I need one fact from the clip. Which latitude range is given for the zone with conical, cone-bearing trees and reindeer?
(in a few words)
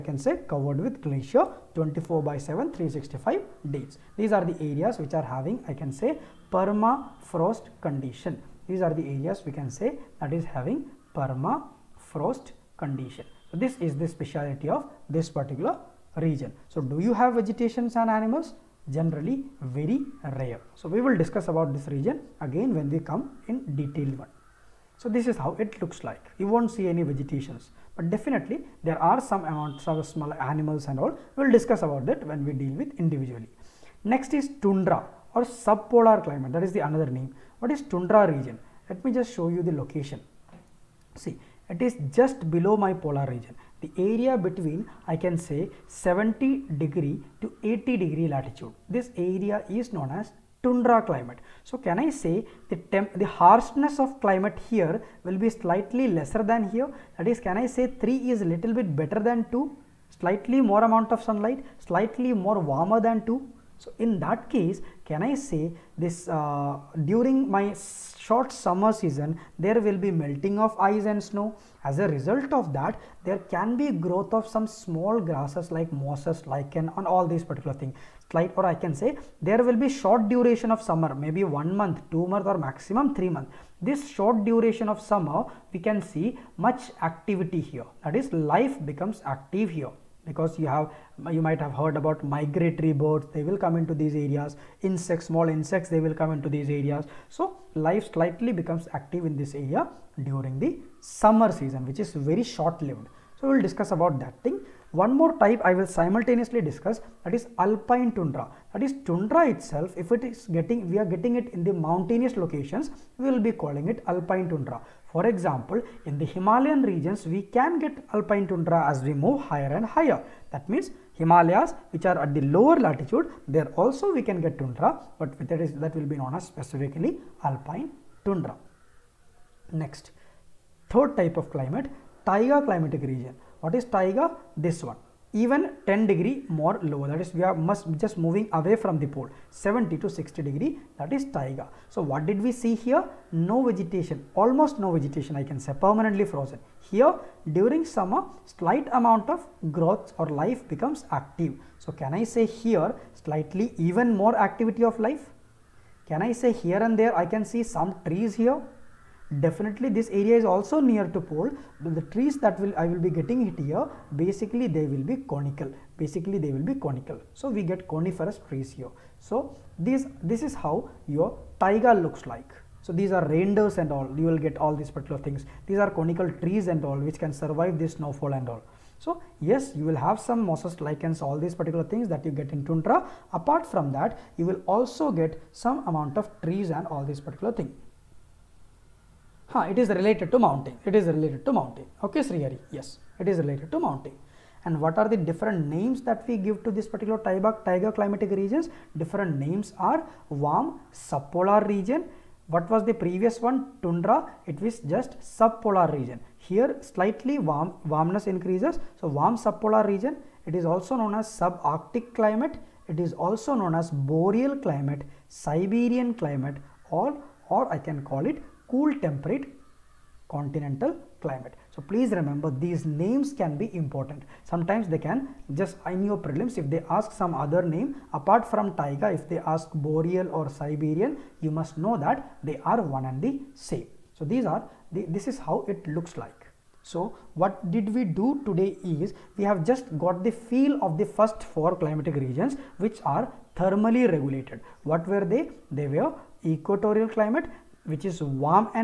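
70 to 60 degrees.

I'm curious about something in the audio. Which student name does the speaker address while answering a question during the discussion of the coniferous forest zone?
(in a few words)
Srihari.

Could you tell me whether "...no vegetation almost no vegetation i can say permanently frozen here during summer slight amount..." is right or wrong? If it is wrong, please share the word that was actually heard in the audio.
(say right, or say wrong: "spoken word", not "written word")
right.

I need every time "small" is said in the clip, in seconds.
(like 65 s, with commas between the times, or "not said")
30 s, 74 s, 95 s.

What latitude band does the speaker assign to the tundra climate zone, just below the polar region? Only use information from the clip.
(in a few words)
70 to 80 degrees.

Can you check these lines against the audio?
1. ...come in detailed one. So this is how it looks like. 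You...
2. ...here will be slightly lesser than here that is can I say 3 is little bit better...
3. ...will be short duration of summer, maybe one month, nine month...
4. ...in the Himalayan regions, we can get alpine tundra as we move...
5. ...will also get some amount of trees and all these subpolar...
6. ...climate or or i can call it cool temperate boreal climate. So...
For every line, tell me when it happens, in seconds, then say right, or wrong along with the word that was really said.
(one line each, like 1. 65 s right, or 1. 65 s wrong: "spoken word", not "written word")
1. 23 s right
2. 54 s right
3. 79 s wrong: "two", not "nine"
4. 116 s right
5. 184 s wrong: "particular", not "subpolar"
6. 216 s wrong: "continental", not "boreal".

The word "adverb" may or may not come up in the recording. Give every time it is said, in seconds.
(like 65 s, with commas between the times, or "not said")
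not said.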